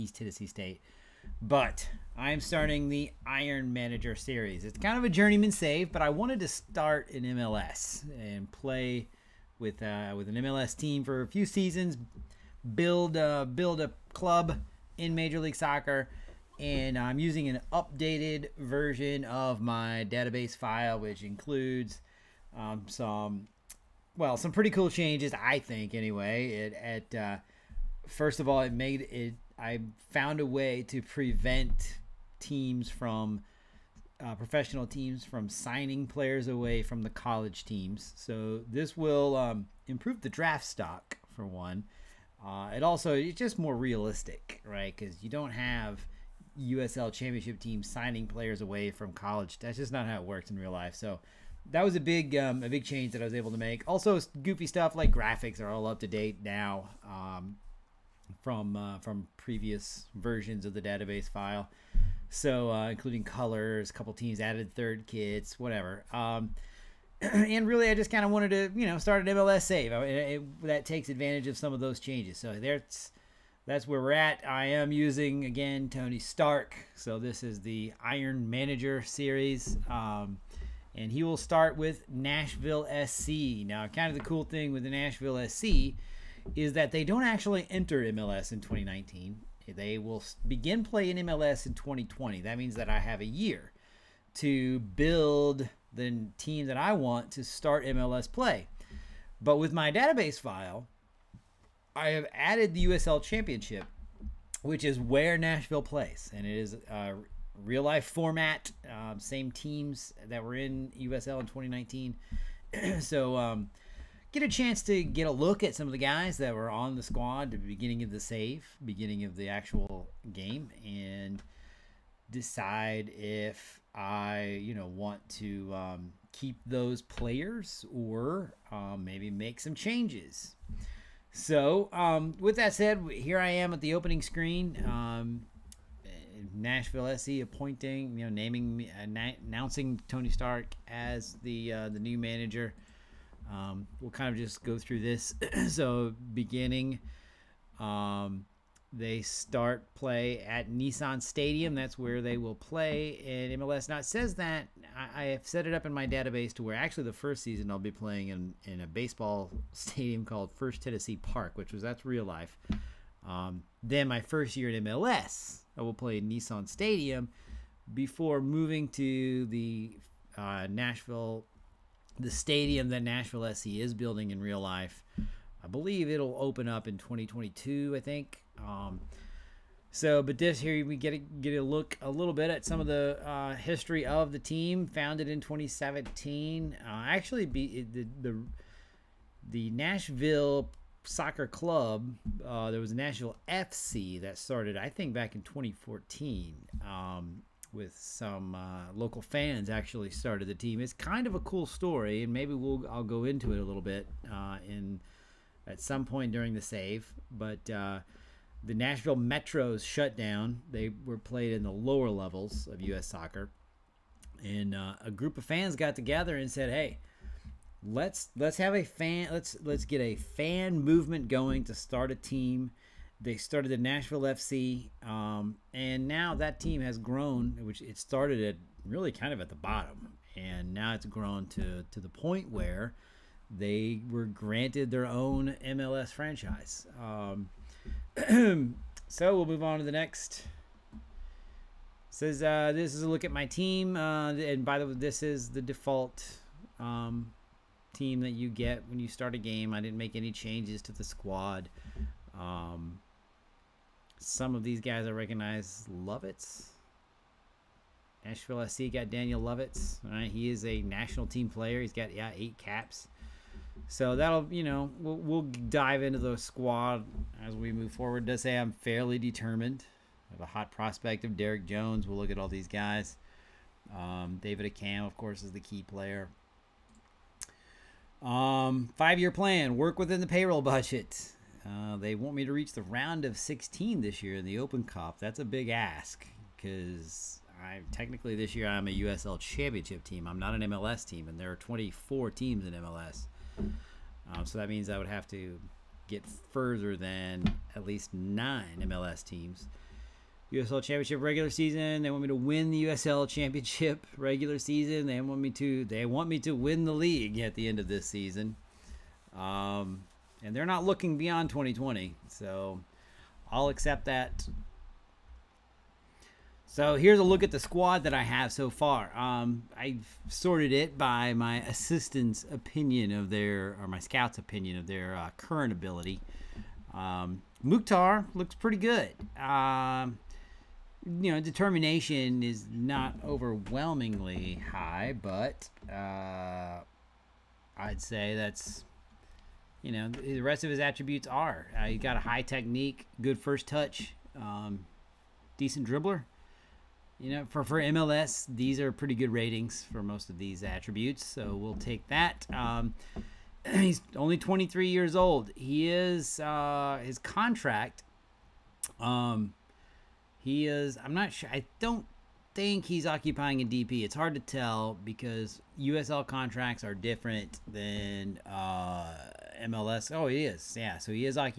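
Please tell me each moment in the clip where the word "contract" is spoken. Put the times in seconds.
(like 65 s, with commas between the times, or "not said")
357 s, 366 s.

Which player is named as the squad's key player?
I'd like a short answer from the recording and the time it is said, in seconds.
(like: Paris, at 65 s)
David Accam, at 274 s.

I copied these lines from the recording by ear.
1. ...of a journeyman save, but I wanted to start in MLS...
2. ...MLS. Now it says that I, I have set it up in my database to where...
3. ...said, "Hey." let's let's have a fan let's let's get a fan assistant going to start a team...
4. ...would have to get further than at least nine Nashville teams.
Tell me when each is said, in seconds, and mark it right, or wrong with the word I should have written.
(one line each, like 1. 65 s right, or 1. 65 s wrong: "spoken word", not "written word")
1. 4 s right
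2. 153 s right
3. 216 s wrong: "movement", not "assistant"
4. 294 s wrong: "MLS", not "Nashville".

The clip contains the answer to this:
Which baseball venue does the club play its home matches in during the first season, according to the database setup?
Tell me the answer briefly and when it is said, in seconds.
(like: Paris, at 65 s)
First Tennessee Park, at 160 s.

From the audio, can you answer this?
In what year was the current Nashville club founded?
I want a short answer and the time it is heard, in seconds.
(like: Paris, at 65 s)
2017, at 185 s.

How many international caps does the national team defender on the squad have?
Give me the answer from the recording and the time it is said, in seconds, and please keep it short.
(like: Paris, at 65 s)
8, at 262 s.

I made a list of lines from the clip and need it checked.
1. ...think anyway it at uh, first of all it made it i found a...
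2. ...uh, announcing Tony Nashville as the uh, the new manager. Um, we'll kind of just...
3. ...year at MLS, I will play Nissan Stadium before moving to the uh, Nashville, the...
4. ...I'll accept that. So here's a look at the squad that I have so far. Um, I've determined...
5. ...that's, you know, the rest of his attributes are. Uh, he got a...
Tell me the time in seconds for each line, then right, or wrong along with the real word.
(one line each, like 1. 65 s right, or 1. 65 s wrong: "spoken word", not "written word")
1. 25 s right
2. 138 s wrong: "Stark", not "Nashville"
3. 164 s right
4. 313 s wrong: "sorted", not "determined"
5. 338 s right.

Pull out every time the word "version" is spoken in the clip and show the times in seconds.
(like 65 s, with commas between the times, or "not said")
18 s, 60 s.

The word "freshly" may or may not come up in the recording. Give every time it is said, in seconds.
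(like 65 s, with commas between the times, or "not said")
not said.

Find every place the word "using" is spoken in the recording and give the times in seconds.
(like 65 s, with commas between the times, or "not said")
17 s, 74 s.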